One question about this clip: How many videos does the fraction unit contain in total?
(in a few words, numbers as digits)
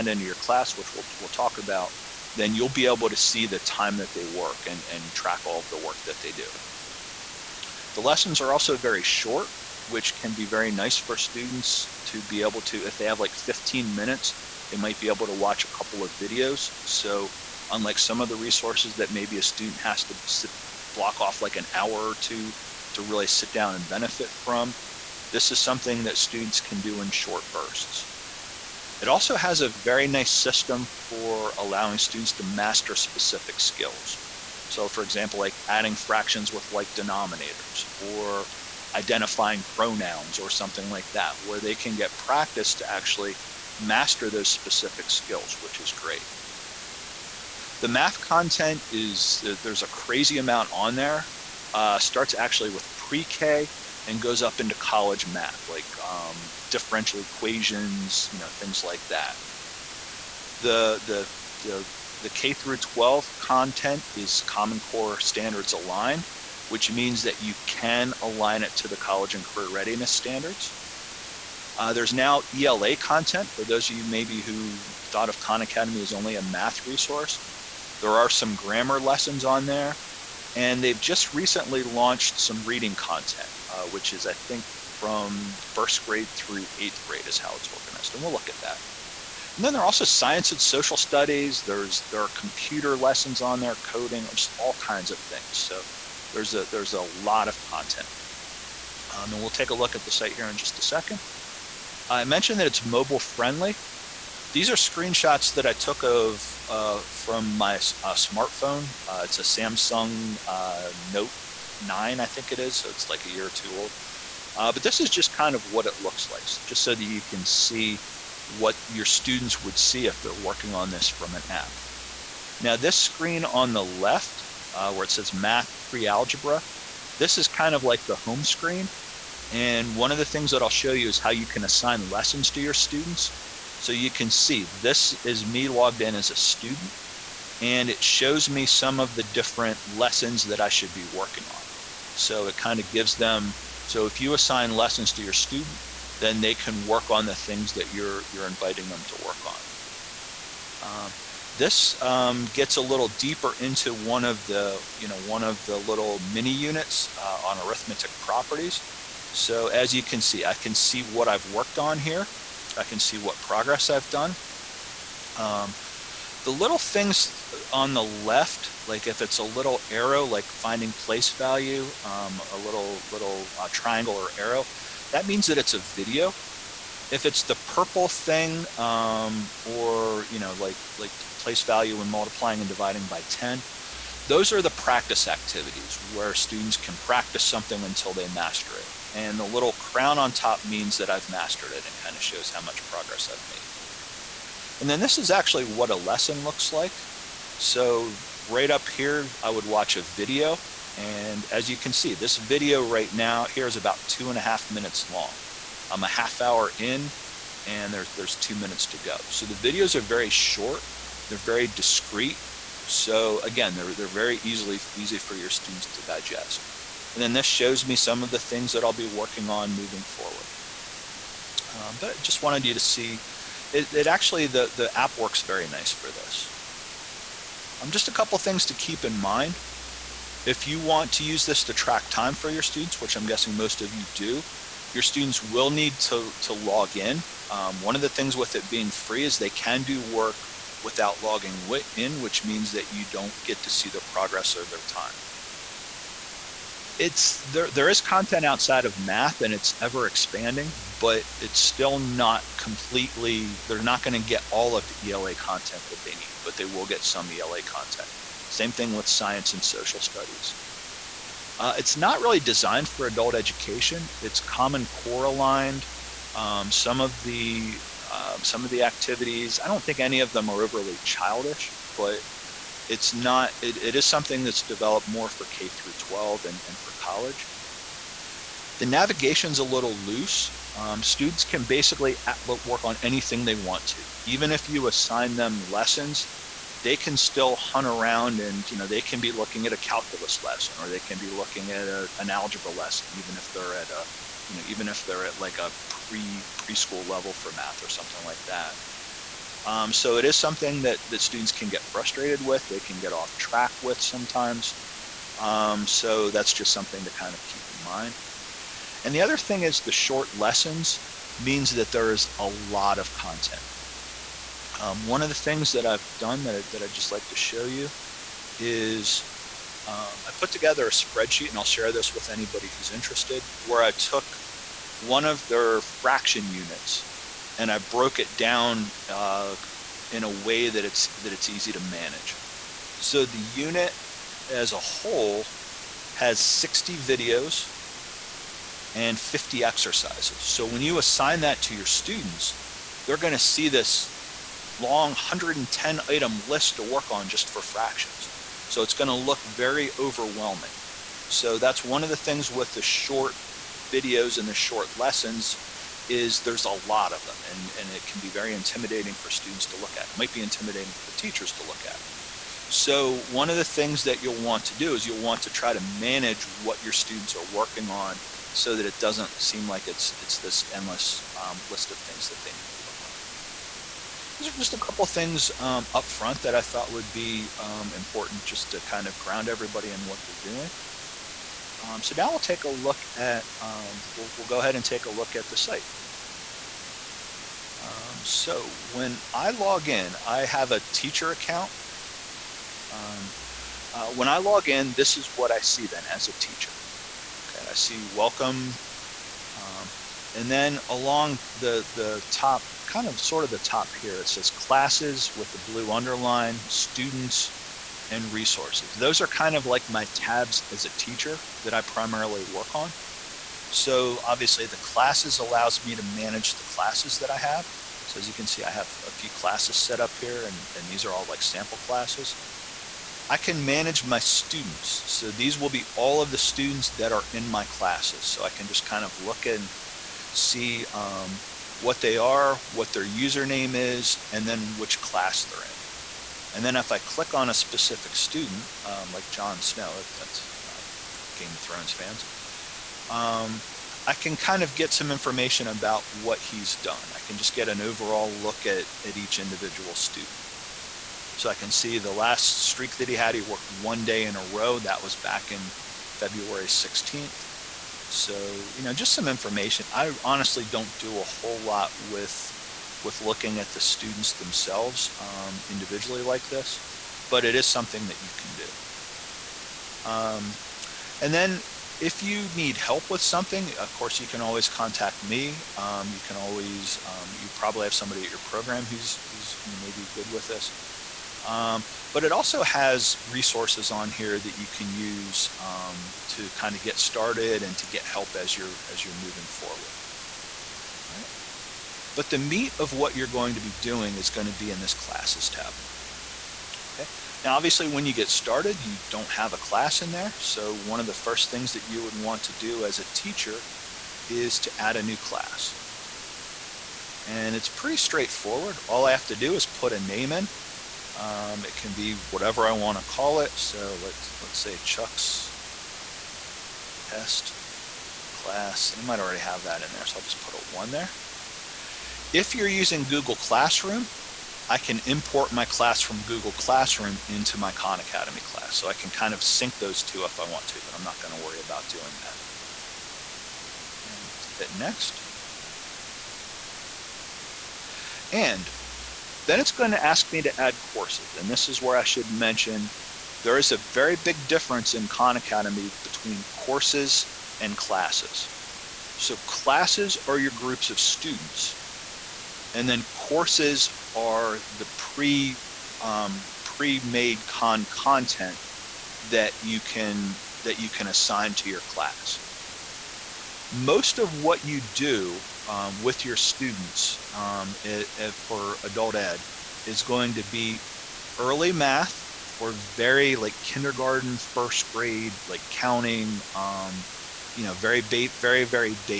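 60.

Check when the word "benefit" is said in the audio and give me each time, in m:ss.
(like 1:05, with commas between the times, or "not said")
0:23.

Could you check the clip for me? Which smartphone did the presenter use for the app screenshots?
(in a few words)
Samsung Note 9.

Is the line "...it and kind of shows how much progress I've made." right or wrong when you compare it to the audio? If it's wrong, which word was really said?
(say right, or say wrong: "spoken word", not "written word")
right.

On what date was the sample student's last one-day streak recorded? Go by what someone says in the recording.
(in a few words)
February 16th.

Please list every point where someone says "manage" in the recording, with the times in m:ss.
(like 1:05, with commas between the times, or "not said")
5:31, 6:05, 6:56, 7:03.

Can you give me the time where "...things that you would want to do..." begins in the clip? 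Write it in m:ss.
8:21.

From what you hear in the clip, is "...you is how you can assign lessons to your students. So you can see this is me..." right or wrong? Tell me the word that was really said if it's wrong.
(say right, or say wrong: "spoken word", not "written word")
right.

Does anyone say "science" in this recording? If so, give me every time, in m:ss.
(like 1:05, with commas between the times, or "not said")
1:30, 4:19.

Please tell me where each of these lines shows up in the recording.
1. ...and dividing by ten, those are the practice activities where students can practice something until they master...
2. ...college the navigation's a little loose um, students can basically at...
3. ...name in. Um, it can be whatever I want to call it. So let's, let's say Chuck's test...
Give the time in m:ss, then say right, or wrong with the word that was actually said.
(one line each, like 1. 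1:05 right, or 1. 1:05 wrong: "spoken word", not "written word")
1. 3:02 right
2. 4:37 right
3. 8:29 right.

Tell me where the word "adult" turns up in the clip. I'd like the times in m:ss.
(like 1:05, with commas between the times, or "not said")
4:23, 9:28.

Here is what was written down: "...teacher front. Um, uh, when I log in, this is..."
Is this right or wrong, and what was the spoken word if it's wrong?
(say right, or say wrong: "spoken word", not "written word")
wrong: "account", not "front".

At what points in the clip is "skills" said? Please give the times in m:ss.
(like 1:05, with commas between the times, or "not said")
0:33, 0:45.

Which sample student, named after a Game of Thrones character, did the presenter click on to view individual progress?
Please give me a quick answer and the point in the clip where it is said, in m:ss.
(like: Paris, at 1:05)
Jon Snow, at 7:19.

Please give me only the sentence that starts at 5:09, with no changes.
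And the other thing is the short lessons means that there is a lot of content.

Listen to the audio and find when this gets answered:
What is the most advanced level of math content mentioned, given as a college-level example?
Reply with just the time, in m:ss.
0:56.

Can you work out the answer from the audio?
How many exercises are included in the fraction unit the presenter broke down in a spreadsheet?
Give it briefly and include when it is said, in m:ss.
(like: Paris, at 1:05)
50, at 5:39.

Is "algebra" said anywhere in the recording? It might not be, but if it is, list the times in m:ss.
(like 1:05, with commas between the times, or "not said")
2:05, 4:52.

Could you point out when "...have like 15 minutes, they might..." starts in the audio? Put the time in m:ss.
0:13.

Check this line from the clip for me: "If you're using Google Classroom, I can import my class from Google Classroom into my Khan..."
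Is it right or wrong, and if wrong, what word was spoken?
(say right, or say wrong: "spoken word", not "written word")
right.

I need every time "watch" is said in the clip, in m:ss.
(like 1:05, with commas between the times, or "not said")
0:15, 3:19.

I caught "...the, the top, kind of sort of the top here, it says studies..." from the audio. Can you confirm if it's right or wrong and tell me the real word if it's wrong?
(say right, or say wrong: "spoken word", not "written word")
wrong: "classes", not "studies".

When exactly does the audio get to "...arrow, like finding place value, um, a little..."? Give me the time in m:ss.
2:49.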